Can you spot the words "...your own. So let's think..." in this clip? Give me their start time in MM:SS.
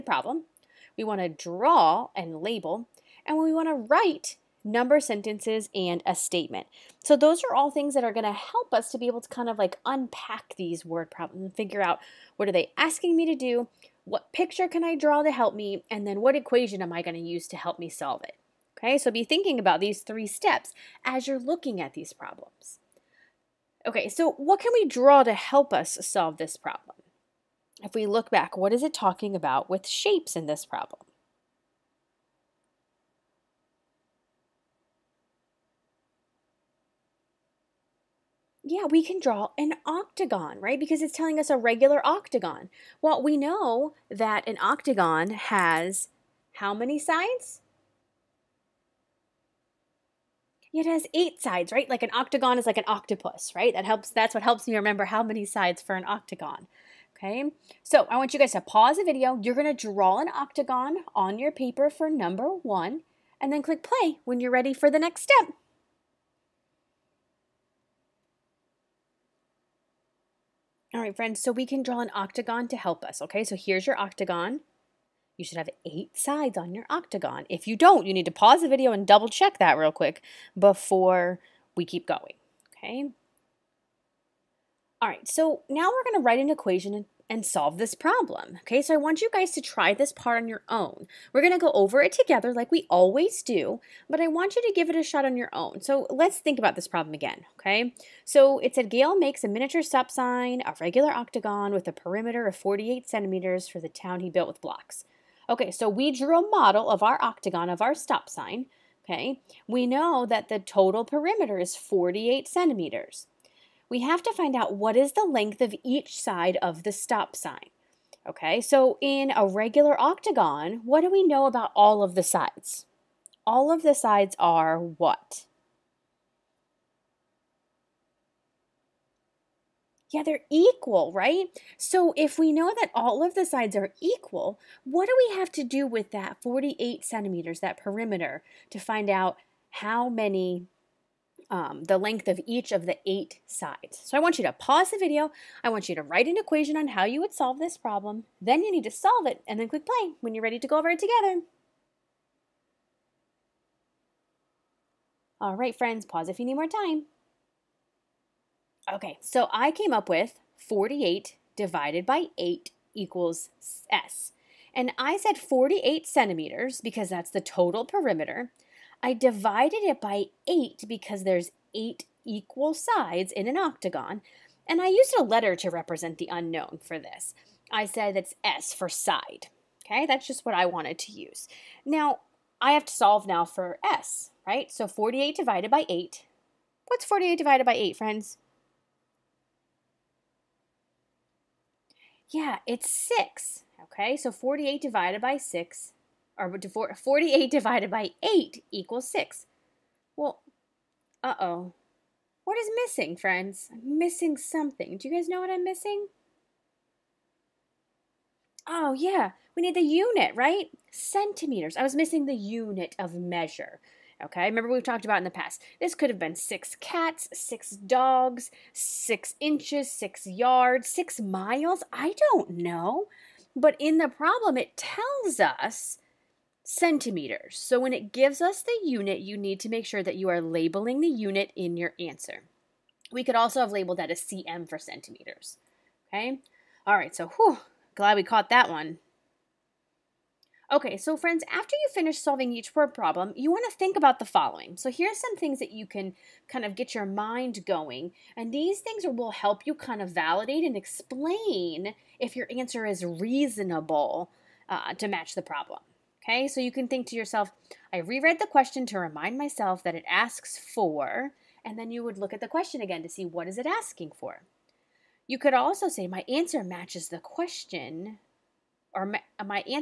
01:35.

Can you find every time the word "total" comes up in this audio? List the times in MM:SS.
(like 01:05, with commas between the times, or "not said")
01:50, 02:47.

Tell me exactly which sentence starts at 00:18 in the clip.
Okay, so be thinking about these three steps as you're looking at these problems.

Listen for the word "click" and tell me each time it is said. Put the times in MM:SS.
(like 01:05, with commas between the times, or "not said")
01:03, 02:29.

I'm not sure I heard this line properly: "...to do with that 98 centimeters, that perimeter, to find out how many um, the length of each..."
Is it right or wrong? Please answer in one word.
wrong.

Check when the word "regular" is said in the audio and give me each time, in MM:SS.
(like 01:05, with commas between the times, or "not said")
00:41, 01:40, 01:59.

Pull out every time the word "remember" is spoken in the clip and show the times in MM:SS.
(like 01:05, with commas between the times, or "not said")
00:54, 03:34.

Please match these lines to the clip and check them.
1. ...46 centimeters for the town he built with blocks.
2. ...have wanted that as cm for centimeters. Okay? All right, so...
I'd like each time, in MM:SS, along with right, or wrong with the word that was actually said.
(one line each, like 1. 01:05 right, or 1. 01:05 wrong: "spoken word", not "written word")
1. 01:42 wrong: "48", not "46"
2. 03:53 wrong: "labeled", not "wanted".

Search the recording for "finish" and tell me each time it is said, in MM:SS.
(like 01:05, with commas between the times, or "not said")
04:01.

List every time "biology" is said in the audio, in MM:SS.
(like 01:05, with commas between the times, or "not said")
not said.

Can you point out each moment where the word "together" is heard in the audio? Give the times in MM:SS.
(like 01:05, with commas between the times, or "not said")
01:32, 02:30.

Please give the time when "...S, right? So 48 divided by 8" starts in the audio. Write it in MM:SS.
03:03.